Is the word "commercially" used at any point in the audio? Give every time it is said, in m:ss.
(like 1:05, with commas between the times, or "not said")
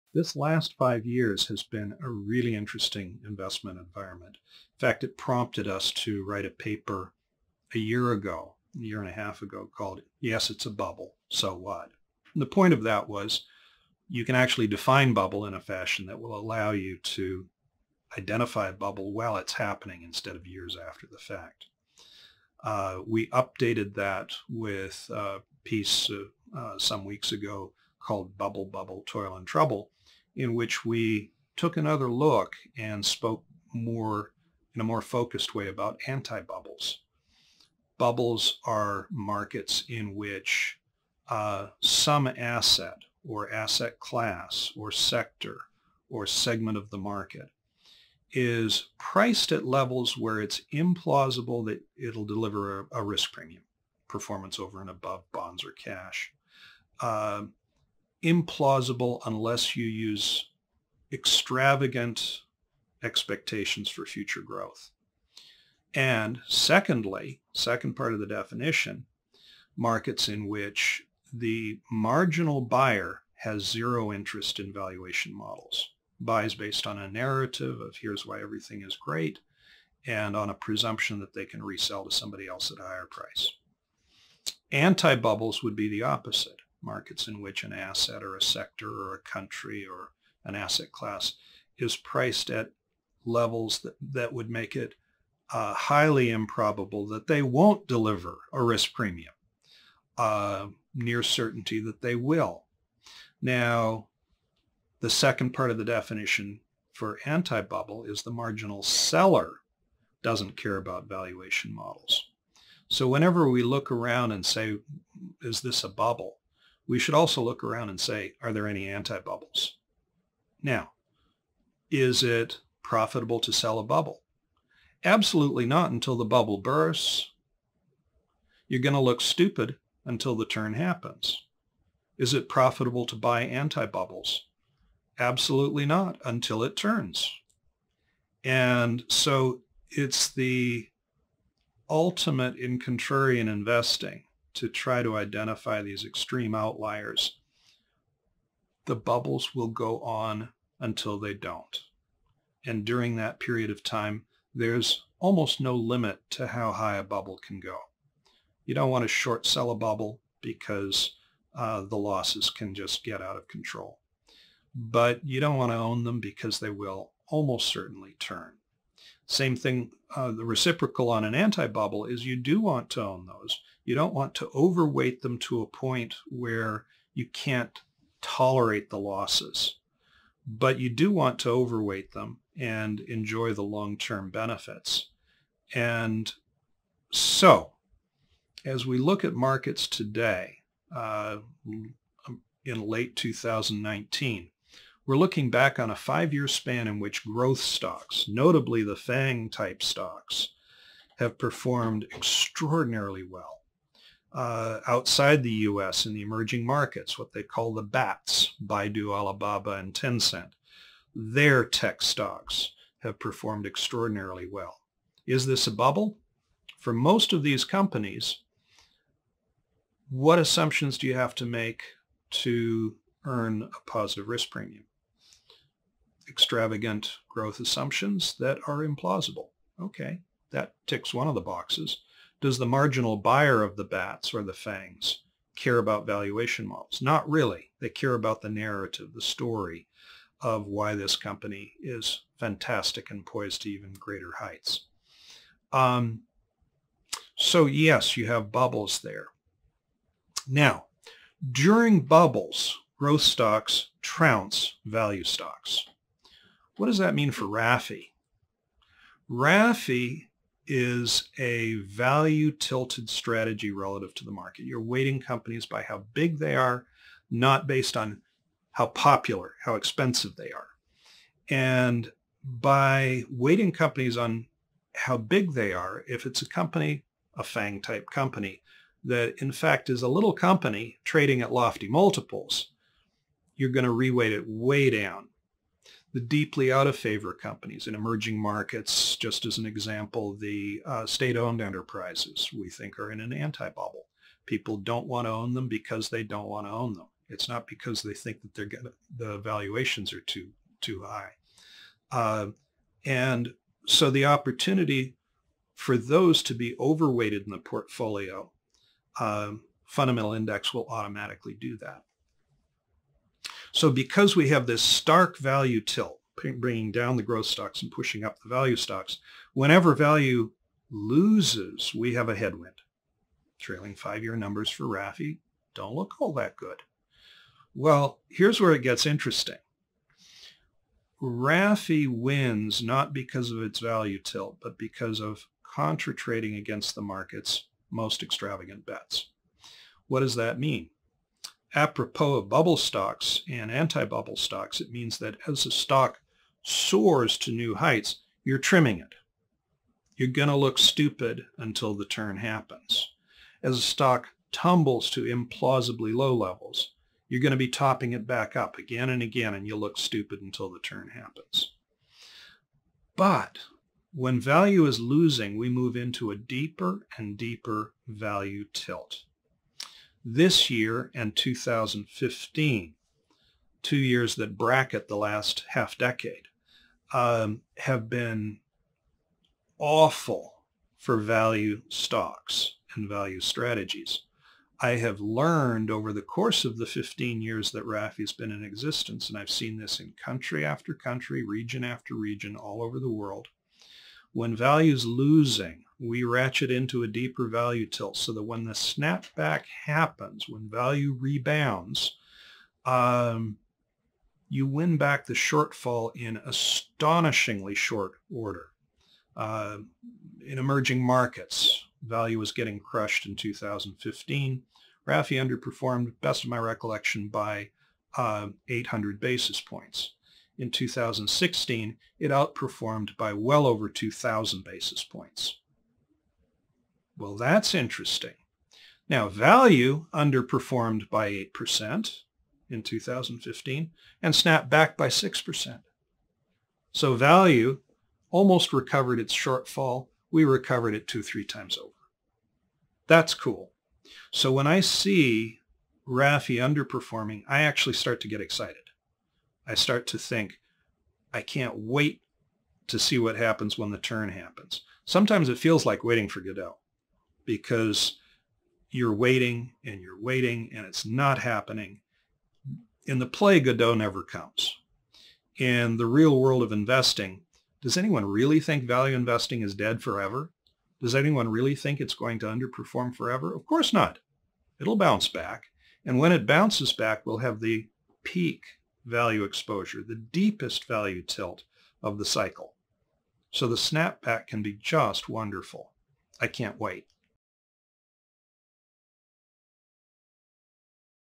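not said.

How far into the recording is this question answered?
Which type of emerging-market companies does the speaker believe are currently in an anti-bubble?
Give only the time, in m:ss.
4:51.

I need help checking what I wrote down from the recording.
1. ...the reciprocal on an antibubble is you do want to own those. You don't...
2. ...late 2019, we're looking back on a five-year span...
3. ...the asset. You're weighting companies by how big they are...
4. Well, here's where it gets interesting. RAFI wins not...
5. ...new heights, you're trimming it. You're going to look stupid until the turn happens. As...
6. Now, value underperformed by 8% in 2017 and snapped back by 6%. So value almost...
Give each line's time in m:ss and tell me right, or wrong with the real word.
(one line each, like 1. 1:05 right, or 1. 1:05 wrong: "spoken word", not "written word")
1. 2:50 right
2. 3:12 right
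3. 4:24 wrong: "market", not "asset"
4. 5:27 right
5. 5:47 right
6. 7:09 wrong: "2015", not "2017".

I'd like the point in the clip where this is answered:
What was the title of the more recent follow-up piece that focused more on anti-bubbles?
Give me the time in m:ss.
0:28.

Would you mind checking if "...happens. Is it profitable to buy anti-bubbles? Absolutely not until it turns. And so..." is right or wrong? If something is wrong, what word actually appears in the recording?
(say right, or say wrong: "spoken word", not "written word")
right.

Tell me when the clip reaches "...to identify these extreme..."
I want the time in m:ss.
2:25.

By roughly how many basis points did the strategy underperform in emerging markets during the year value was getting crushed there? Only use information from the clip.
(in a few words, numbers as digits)
800.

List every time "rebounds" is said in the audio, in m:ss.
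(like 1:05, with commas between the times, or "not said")
6:41.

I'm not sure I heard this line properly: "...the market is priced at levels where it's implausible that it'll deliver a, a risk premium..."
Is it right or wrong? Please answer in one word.
right.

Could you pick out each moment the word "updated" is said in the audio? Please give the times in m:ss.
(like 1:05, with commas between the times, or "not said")
0:23.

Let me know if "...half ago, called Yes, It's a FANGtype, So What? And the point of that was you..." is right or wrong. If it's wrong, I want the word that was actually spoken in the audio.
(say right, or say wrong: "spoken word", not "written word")
wrong: "Bubble", not "FANGtype".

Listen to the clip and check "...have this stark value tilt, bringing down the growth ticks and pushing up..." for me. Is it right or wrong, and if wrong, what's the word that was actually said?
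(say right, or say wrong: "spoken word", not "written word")
wrong: "stocks", not "ticks".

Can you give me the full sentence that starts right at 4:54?
People don't want to own them because they don't want to own them.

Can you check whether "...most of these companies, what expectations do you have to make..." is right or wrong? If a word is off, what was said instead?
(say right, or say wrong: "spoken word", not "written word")
wrong: "assumptions", not "expectations".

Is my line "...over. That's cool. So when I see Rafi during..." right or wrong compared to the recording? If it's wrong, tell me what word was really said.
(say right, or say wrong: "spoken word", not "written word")
wrong: "underperforming", not "during".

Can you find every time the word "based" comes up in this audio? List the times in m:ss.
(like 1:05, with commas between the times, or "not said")
1:16, 4:27.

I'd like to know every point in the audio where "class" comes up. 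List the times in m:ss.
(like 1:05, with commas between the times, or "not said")
0:43, 1:30.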